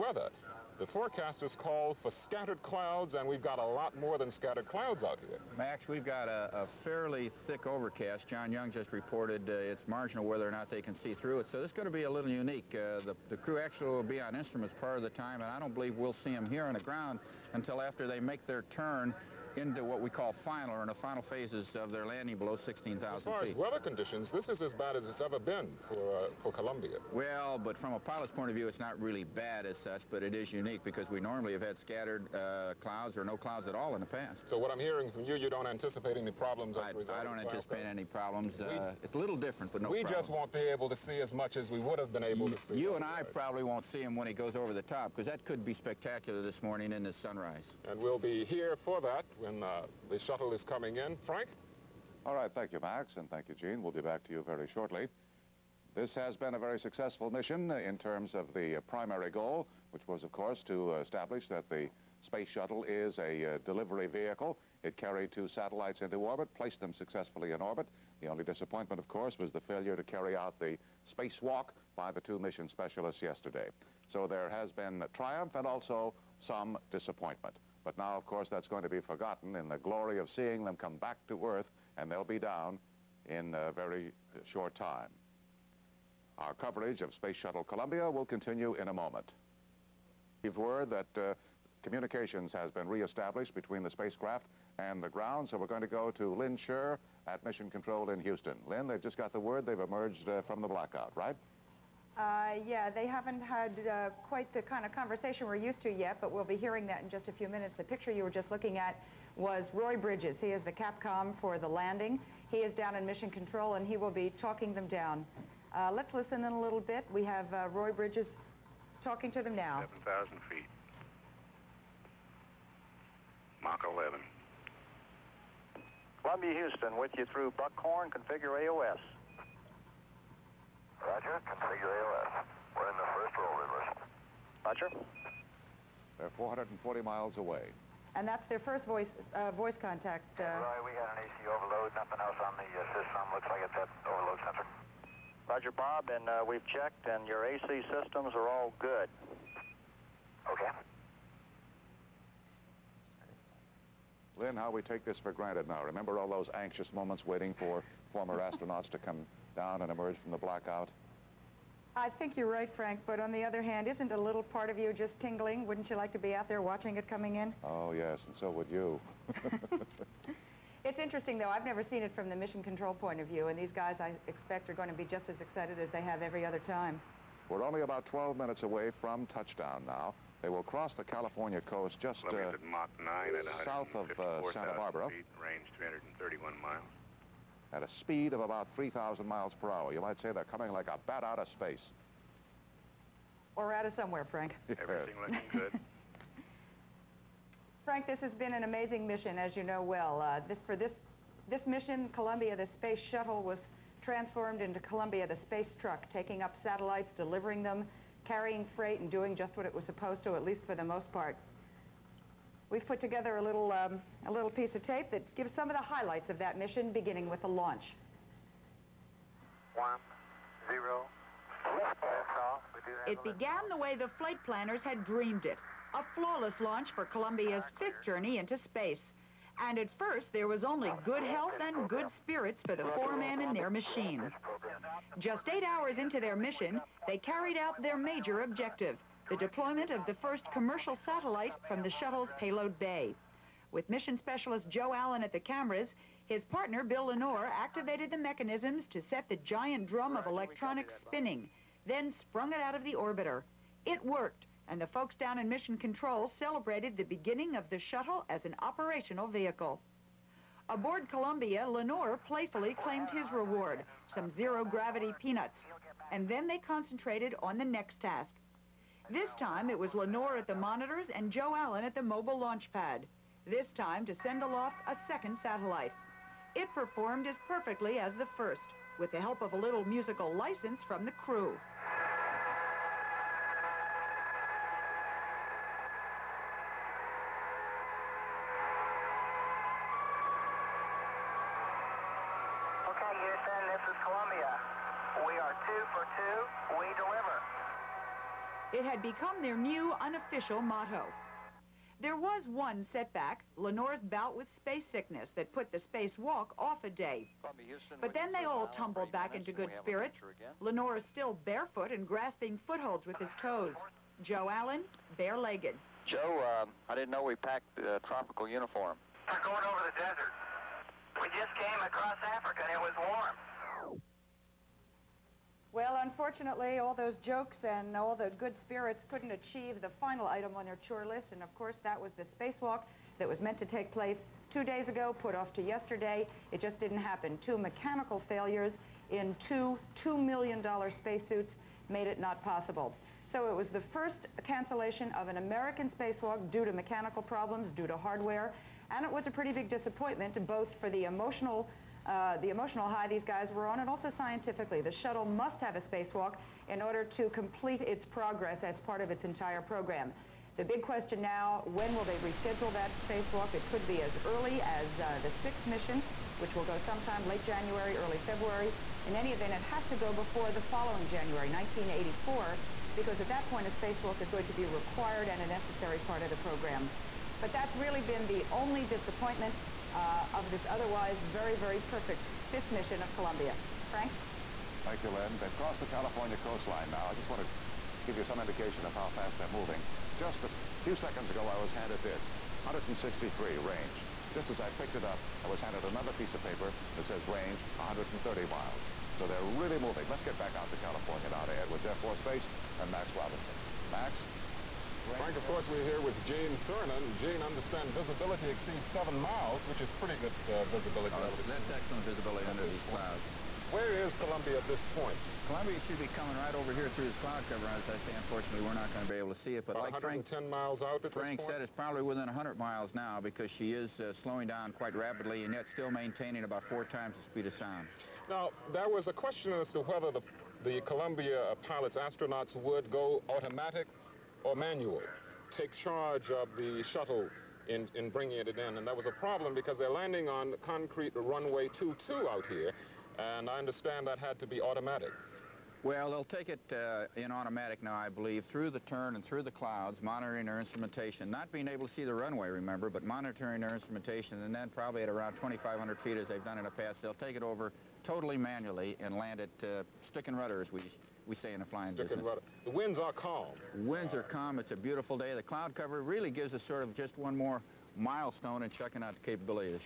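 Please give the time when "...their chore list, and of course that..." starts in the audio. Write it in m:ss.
5:30.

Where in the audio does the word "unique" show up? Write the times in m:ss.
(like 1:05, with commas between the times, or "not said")
0:12, 0:30.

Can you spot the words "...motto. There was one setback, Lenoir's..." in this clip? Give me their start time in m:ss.
5:00.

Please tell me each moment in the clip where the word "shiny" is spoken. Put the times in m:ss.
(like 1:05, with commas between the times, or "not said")
not said.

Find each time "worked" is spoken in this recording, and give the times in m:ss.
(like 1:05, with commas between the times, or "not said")
4:14.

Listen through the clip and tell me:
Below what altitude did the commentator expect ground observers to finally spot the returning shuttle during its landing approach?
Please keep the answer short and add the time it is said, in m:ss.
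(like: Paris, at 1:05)
16,000 feet, at 0:22.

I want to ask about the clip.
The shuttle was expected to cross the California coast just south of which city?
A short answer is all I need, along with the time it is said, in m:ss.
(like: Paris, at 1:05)
Santa Barbara, at 3:04.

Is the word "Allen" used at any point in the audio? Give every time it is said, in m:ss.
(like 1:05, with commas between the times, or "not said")
4:04, 4:31, 5:14.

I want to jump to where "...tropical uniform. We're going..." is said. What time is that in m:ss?
5:18.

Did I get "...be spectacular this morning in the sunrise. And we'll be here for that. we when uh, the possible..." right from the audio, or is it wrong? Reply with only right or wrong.
wrong.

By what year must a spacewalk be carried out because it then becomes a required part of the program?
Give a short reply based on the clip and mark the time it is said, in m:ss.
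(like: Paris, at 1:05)
1984, at 6:11.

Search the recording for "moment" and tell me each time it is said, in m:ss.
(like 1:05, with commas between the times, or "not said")
1:28, 2:36.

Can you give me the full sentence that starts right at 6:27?
I just want to give you some indication of how fast they're moving.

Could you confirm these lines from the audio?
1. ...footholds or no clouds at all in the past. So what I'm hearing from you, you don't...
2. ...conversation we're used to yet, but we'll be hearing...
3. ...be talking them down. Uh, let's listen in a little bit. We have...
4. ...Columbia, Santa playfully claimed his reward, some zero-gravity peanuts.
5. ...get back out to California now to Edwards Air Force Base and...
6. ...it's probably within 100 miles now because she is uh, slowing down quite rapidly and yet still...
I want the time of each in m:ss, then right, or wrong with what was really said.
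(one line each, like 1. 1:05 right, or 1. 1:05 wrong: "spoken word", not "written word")
1. 0:32 wrong: "clouds", not "footholds"
2. 1:44 right
3. 1:54 right
4. 4:21 wrong: "Lenoir", not "Santa"
5. 6:40 right
6. 7:01 right.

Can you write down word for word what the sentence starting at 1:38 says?
Lynn, they've just got the word they've emerged uh, from the blackout, right?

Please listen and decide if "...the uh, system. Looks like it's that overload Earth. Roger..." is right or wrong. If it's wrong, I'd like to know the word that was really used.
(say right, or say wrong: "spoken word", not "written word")
wrong: "Center", not "Earth".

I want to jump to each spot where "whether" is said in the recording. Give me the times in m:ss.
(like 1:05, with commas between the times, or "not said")
0:10, 7:09.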